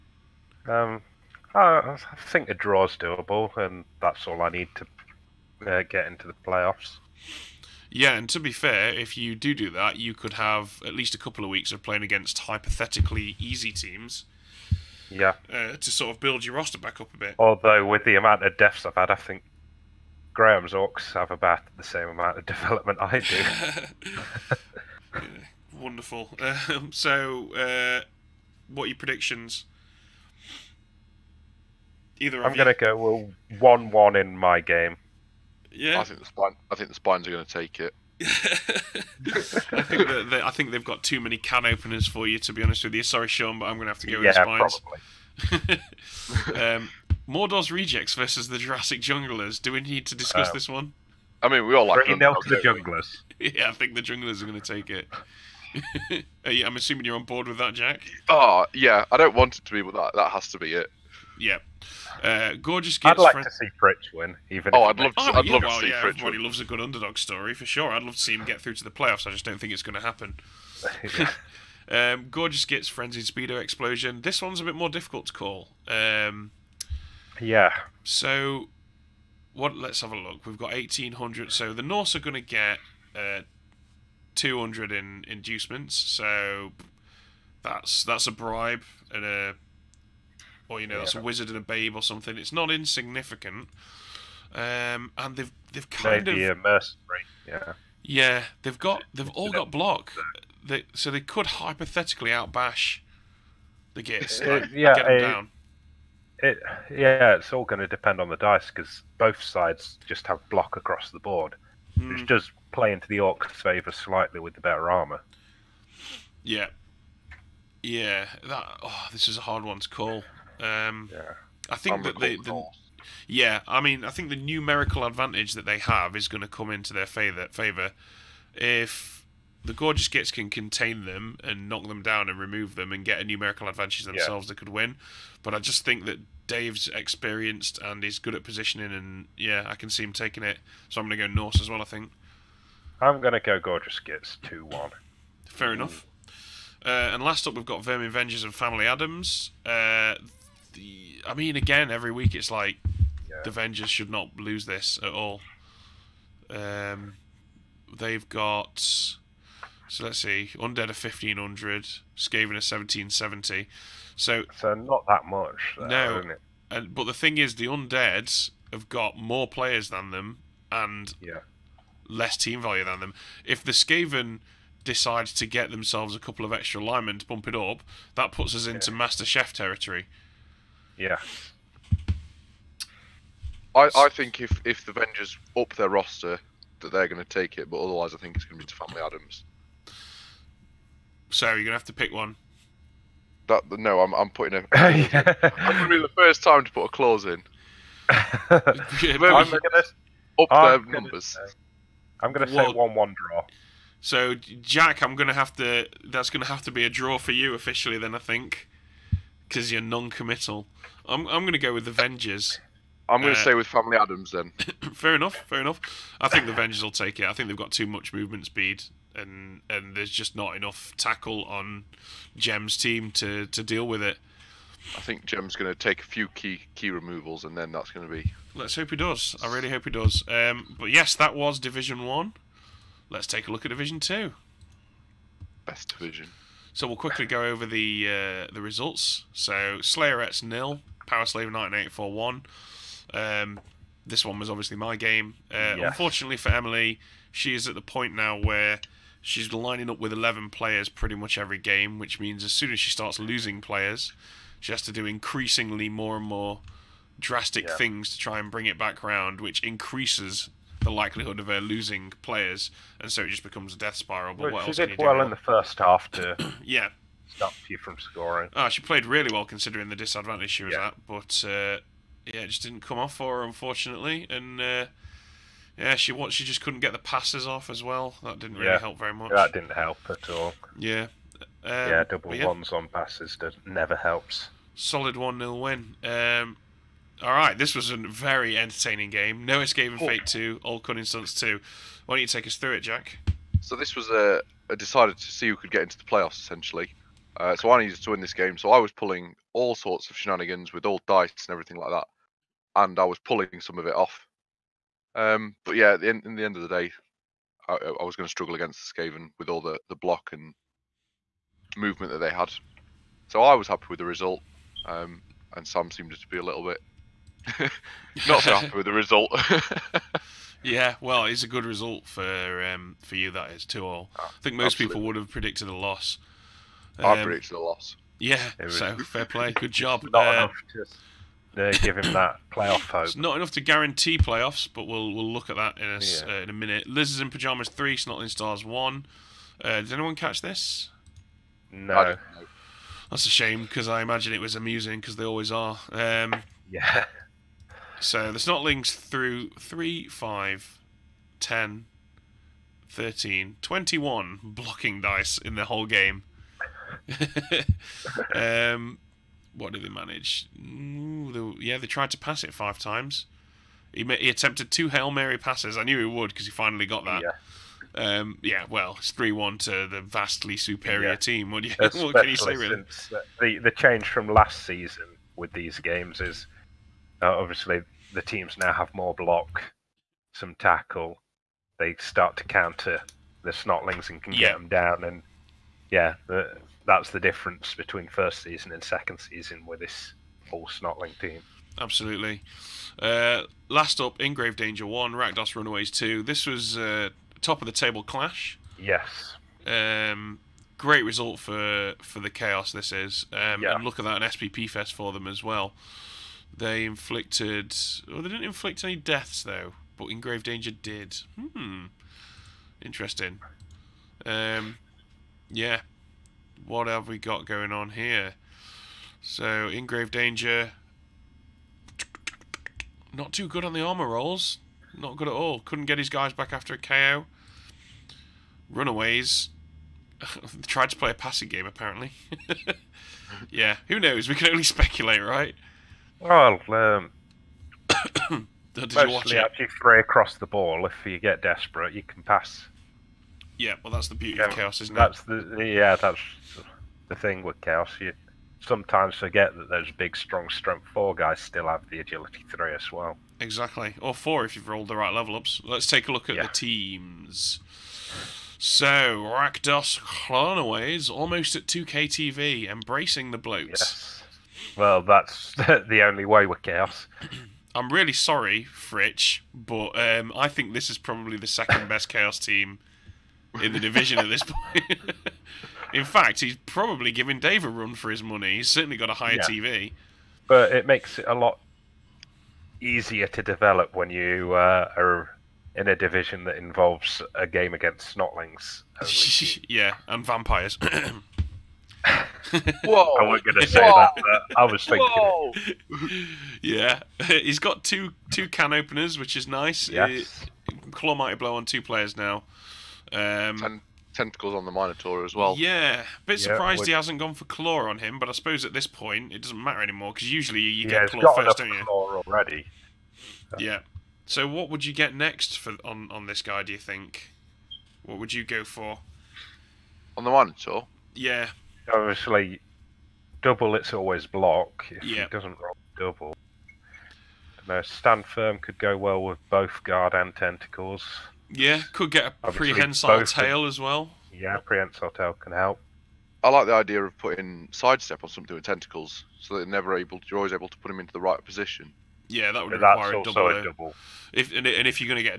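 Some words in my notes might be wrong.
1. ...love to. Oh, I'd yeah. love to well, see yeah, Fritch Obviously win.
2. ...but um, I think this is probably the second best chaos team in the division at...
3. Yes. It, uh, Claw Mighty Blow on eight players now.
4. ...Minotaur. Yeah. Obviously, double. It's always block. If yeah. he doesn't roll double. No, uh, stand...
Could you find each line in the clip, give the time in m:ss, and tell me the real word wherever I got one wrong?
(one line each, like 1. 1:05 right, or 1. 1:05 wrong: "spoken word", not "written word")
1. 1:04 wrong: "Everybody", not "Obviously"
2. 7:49 right
3. 8:19 wrong: "two", not "eight"
4. 8:40 right.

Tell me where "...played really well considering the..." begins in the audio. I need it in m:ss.
4:28.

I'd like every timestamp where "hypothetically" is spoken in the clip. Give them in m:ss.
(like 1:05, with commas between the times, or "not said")
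0:12, 1:41.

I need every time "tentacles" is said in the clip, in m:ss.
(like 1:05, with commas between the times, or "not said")
8:24, 8:50, 8:58.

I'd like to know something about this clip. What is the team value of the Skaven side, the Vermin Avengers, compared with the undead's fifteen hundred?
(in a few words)
1770.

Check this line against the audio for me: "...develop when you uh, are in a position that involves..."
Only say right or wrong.
wrong.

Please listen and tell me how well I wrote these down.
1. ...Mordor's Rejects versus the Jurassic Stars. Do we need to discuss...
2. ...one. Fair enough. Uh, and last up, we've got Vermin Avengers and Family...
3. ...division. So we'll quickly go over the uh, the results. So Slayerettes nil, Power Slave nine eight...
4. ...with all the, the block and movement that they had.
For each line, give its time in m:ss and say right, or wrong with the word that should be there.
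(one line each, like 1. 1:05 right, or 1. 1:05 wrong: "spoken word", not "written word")
1. 0:47 wrong: "Junglers", not "Stars"
2. 2:24 right
3. 3:55 right
4. 5:09 right.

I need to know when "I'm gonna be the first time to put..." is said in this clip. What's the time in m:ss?
3:15.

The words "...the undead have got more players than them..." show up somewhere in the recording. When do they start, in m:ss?
2:47.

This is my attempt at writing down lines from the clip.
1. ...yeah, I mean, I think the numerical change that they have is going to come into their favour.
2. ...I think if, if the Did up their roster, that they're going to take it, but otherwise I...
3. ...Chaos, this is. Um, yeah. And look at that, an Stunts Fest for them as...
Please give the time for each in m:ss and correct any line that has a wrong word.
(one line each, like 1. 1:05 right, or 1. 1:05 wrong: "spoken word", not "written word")
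1. 2:03 wrong: "advantage", not "change"
2. 3:03 wrong: "Avengers", not "Did"
3. 6:42 wrong: "SPP", not "Stunts".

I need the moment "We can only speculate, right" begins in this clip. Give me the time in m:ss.
7:14.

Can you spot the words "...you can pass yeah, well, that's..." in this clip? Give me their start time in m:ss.
7:21.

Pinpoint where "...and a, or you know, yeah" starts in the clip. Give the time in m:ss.
1:29.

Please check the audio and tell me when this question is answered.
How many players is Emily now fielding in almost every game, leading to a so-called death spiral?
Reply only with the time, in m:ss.
4:10.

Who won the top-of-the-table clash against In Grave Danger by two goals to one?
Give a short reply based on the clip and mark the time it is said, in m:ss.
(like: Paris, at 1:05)
Rakdos Runaways, at 6:35.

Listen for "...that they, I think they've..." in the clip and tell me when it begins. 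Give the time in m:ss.
0:40.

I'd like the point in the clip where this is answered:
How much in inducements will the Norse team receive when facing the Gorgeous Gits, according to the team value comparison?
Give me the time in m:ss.
1:24.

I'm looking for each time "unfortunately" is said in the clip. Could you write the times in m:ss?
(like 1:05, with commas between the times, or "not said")
4:05, 4:33.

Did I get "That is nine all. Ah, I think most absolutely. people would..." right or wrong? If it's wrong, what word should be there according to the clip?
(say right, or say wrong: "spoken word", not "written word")
wrong: "two", not "nine".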